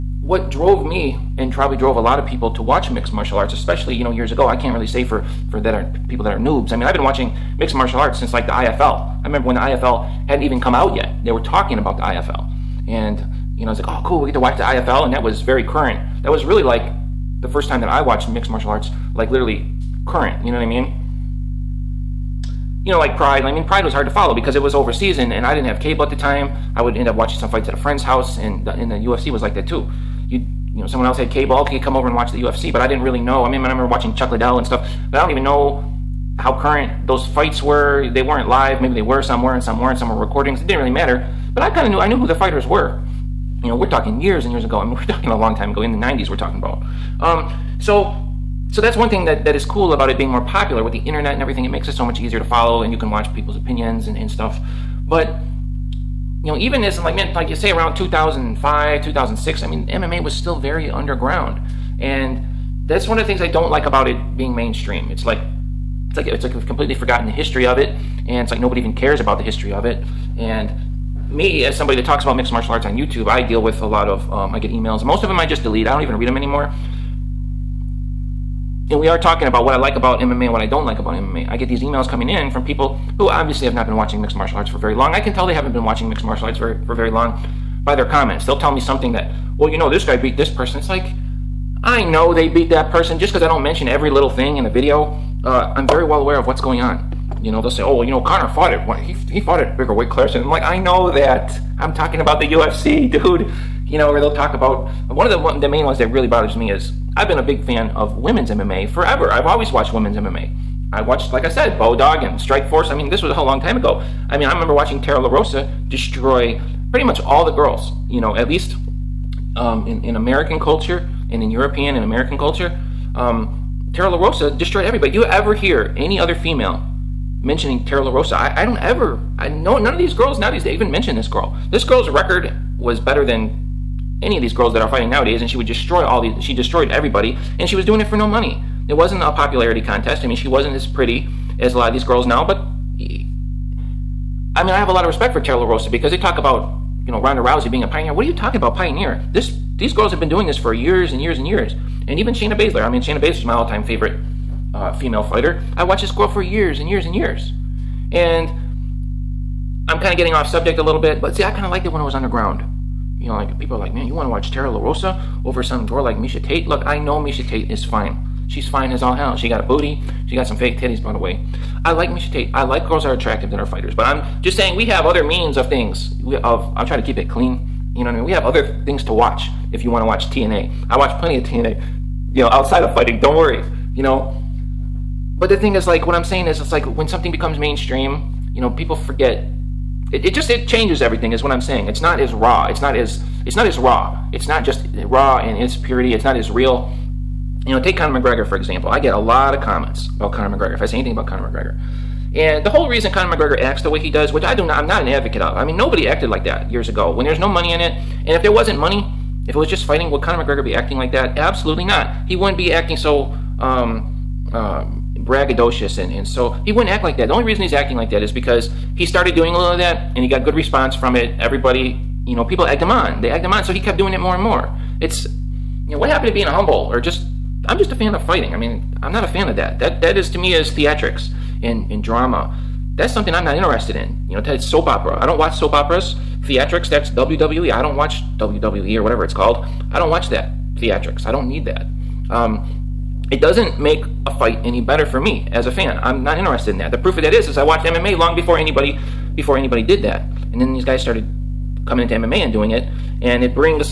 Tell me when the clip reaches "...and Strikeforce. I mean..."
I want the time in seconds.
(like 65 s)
112 s.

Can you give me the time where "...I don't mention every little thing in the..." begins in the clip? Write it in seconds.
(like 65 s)
93 s.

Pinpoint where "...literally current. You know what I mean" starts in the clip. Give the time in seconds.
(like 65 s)
19 s.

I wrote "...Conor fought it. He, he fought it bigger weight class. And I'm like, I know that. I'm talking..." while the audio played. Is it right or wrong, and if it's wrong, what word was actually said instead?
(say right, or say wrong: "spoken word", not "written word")
right.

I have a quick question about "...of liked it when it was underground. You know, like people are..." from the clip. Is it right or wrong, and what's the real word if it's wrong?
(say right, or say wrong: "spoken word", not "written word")
right.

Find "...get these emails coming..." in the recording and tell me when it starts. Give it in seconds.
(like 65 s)
81 s.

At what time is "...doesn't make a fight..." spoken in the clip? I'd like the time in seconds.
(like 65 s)
243 s.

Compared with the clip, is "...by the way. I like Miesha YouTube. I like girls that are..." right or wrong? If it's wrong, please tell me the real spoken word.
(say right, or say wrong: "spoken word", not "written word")
wrong: "Tate", not "YouTube".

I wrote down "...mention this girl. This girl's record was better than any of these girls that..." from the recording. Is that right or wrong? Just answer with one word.
right.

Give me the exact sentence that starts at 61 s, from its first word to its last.
And that's one of the things I don't like about it being mainstream.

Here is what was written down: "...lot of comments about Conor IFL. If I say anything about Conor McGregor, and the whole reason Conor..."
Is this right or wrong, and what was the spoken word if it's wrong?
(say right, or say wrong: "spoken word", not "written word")
wrong: "McGregor", not "IFL".